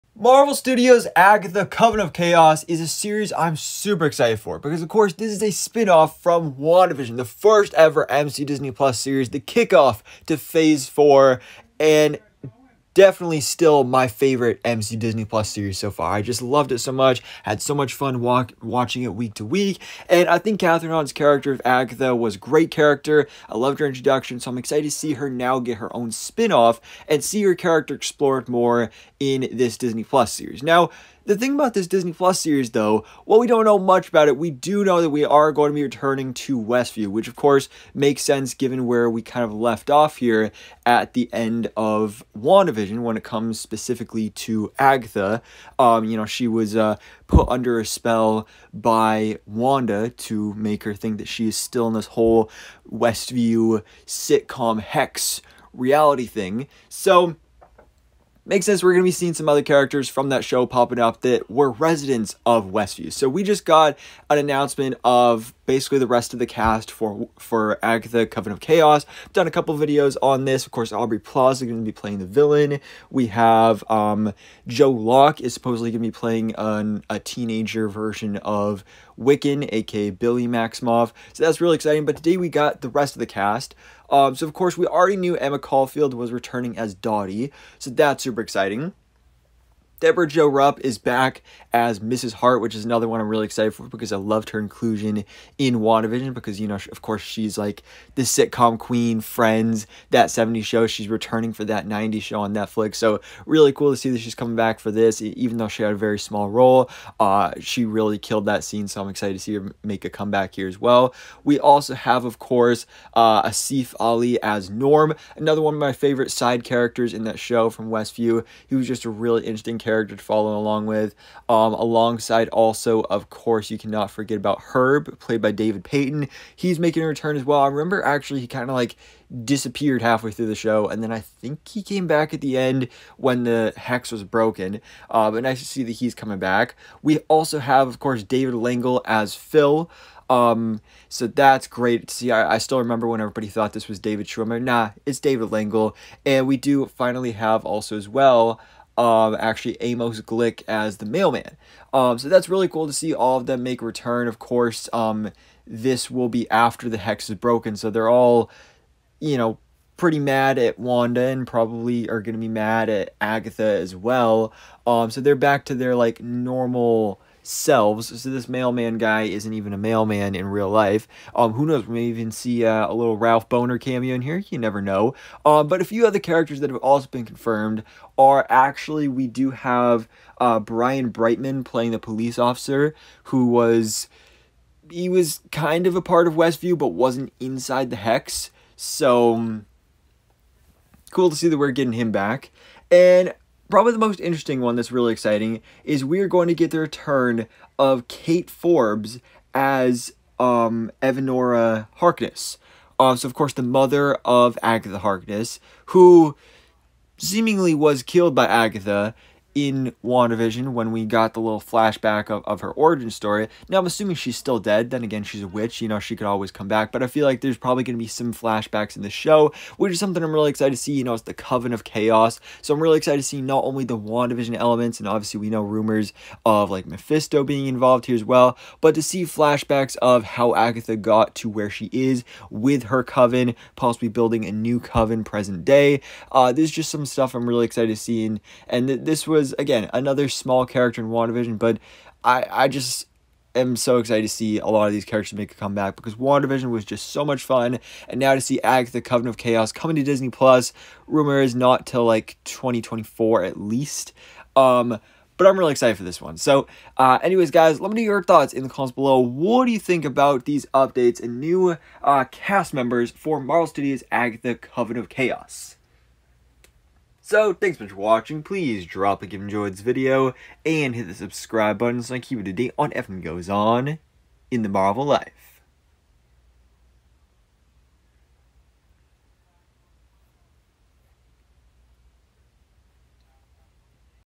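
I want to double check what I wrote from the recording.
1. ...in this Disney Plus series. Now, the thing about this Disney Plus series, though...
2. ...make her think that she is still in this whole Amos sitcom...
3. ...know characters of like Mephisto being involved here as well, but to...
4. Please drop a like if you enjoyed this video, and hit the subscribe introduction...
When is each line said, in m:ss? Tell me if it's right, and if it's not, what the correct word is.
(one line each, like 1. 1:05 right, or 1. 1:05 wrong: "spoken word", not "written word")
1. 0:29 right
2. 0:50 wrong: "Westview", not "Amos"
3. 3:45 wrong: "rumors", not "characters"
4. 4:28 wrong: "button", not "introduction".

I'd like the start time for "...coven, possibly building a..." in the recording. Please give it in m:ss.
3:53.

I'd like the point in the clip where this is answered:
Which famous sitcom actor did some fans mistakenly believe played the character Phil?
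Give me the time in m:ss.
2:23.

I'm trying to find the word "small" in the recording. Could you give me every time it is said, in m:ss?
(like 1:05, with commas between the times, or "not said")
1:46, 4:00.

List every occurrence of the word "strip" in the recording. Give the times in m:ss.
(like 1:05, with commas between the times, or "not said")
not said.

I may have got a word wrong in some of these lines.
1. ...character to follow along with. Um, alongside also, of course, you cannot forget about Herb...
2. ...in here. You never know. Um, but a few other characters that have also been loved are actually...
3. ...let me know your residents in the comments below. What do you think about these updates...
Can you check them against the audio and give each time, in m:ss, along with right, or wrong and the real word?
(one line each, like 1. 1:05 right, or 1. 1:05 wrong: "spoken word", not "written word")
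1. 1:59 right
2. 2:54 wrong: "confirmed", not "loved"
3. 4:17 wrong: "thoughts", not "residents".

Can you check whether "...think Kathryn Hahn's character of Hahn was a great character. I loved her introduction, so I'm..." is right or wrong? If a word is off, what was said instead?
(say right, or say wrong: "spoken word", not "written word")
wrong: "Agatha", not "Hahn".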